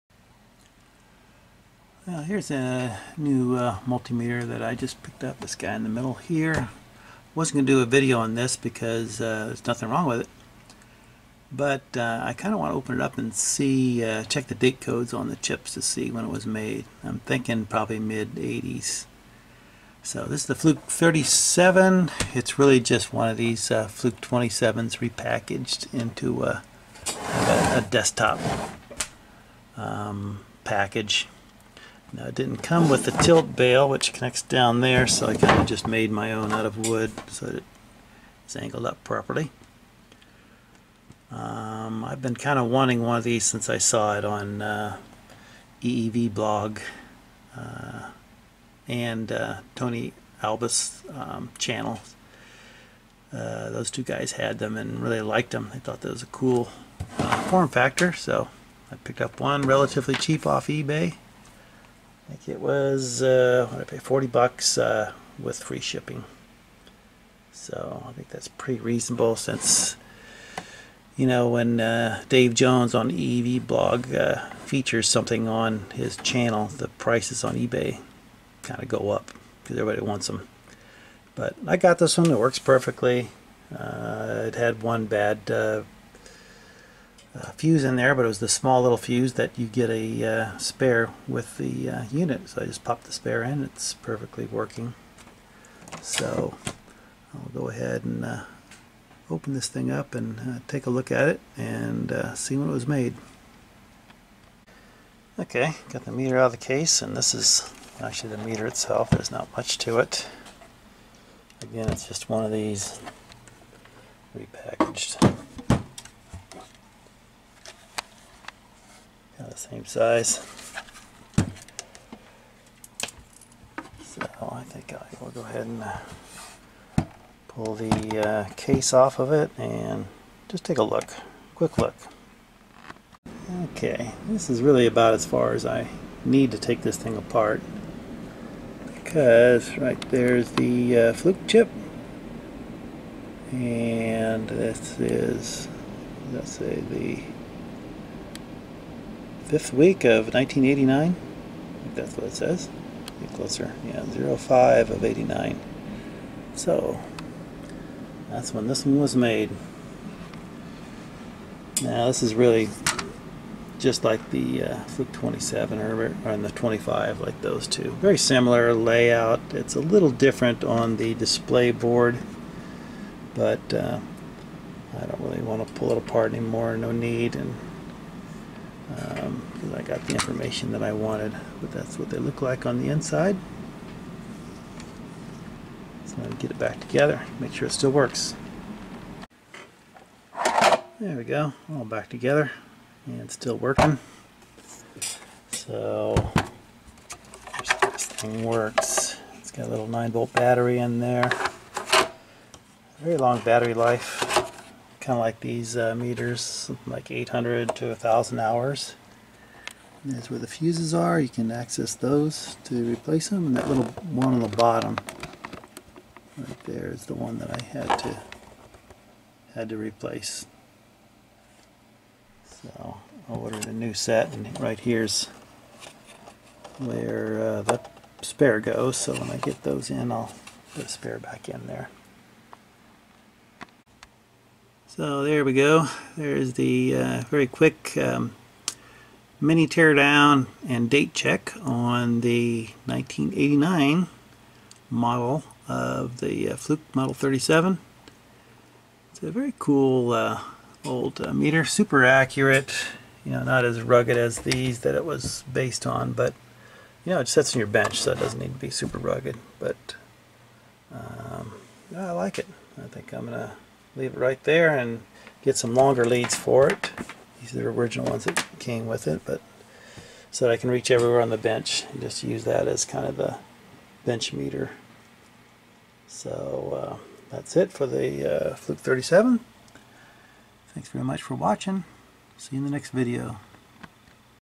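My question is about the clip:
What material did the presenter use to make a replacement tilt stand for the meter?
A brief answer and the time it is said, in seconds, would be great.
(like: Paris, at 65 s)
Wood, at 36 s.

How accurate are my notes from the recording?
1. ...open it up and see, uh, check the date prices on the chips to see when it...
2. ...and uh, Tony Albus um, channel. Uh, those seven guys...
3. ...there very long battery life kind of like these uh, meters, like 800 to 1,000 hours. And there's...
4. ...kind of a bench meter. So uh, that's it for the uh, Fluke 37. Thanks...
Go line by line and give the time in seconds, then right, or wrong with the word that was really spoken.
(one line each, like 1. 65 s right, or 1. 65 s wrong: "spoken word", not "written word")
1. 12 s wrong: "codes", not "prices"
2. 48 s wrong: "two", not "seven"
3. 200 s right
4. 272 s right.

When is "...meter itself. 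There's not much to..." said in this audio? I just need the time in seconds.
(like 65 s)
108 s.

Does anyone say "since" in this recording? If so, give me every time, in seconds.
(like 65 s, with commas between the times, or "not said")
43 s, 69 s.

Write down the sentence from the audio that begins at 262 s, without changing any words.
I think I'm going to leave it right there and get some longer leads for it.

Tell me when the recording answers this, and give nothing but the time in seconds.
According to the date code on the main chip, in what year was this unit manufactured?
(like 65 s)
149 s.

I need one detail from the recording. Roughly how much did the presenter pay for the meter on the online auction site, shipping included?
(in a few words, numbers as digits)
$40.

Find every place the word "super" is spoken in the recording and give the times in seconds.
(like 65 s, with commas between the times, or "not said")
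251 s, 258 s.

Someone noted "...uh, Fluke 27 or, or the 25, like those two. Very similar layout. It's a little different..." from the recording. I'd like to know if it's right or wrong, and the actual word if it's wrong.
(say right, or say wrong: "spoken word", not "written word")
right.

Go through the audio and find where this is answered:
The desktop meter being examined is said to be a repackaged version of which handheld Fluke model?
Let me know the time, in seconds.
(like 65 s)
23 s.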